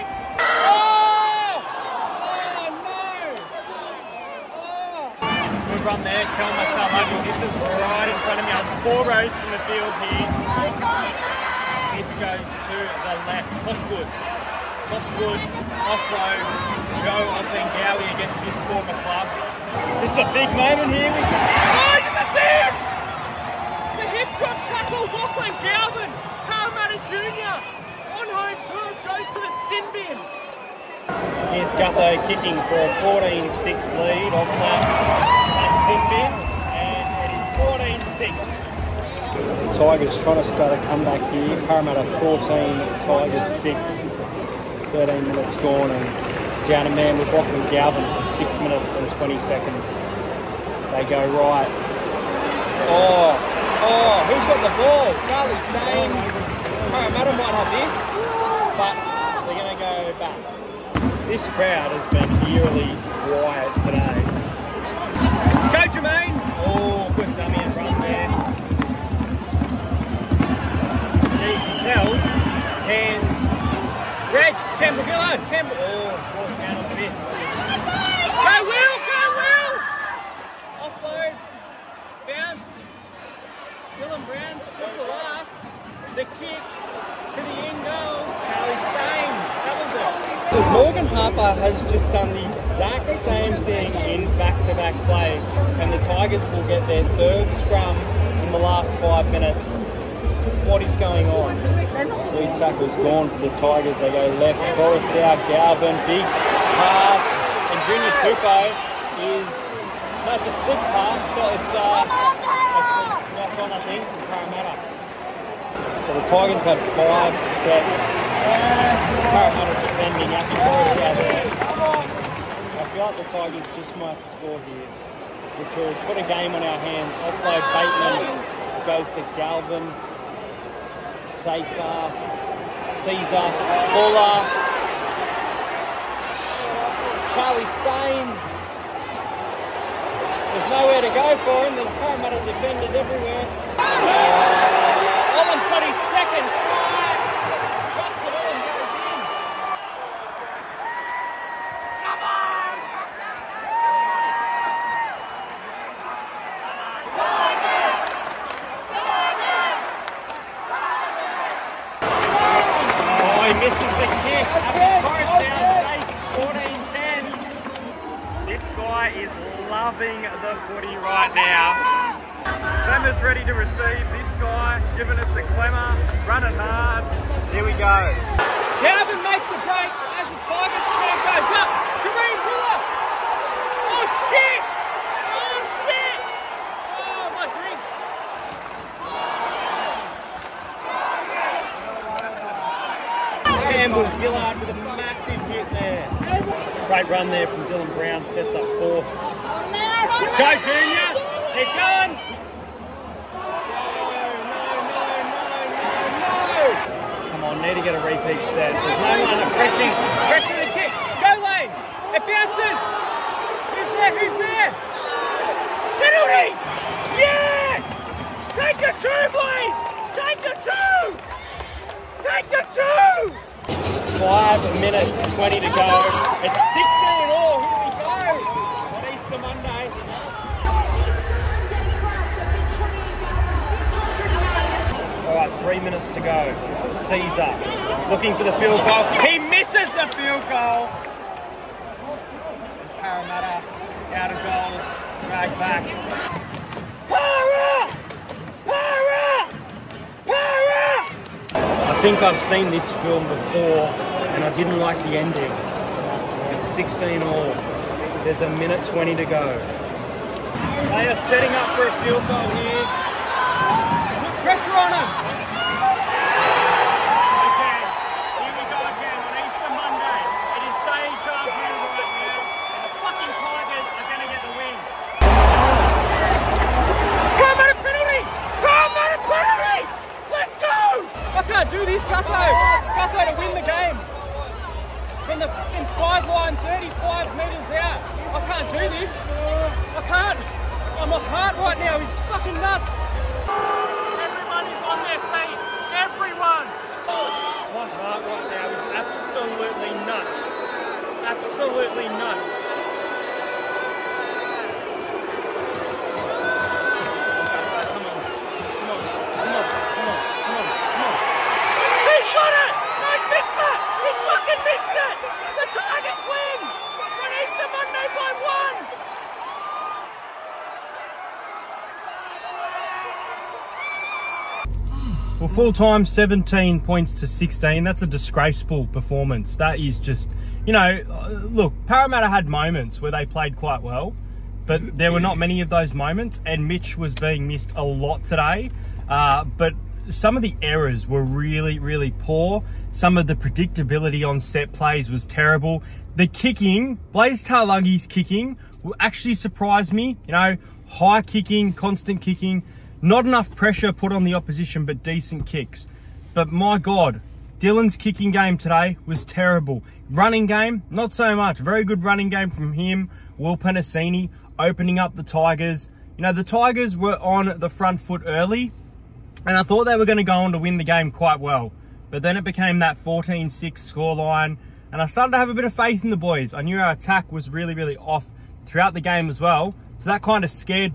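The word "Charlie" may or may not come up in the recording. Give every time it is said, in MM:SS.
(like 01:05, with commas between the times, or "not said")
00:55, 02:17.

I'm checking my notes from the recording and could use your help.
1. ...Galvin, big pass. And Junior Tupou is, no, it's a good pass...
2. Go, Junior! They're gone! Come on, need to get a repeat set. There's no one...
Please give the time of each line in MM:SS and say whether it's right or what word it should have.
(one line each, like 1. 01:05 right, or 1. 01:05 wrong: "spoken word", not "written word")
1. 01:45 right
2. 03:19 right.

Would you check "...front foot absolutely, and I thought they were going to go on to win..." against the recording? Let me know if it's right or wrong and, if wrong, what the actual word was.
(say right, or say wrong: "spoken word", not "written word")
wrong: "early", not "absolutely".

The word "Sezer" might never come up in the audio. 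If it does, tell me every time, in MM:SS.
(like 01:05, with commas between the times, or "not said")
02:13, 03:56.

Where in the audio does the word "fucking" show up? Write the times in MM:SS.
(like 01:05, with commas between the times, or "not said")
04:33, 04:45, 04:52.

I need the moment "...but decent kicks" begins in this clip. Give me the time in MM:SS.
05:54.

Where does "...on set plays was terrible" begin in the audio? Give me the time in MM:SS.
05:44.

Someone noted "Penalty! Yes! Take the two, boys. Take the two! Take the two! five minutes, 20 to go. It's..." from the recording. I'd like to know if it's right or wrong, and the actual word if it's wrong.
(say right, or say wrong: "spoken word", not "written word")
right.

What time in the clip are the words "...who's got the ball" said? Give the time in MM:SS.
00:54.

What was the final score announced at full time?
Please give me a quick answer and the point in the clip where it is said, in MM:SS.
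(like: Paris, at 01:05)
17 to 16, at 05:26.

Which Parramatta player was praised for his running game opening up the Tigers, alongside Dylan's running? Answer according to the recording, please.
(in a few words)
Will Penisini.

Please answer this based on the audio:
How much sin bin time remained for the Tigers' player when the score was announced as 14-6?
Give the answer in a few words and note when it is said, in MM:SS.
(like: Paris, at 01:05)
6 minutes and 20 seconds, at 00:48.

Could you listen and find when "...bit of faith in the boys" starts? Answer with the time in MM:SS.
06:15.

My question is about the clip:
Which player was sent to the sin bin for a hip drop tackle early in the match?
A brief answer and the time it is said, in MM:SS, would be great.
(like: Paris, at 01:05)
Lachlan Galvin, at 00:25.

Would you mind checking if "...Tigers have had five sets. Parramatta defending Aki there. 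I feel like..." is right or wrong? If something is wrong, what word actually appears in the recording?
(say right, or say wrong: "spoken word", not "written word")
right.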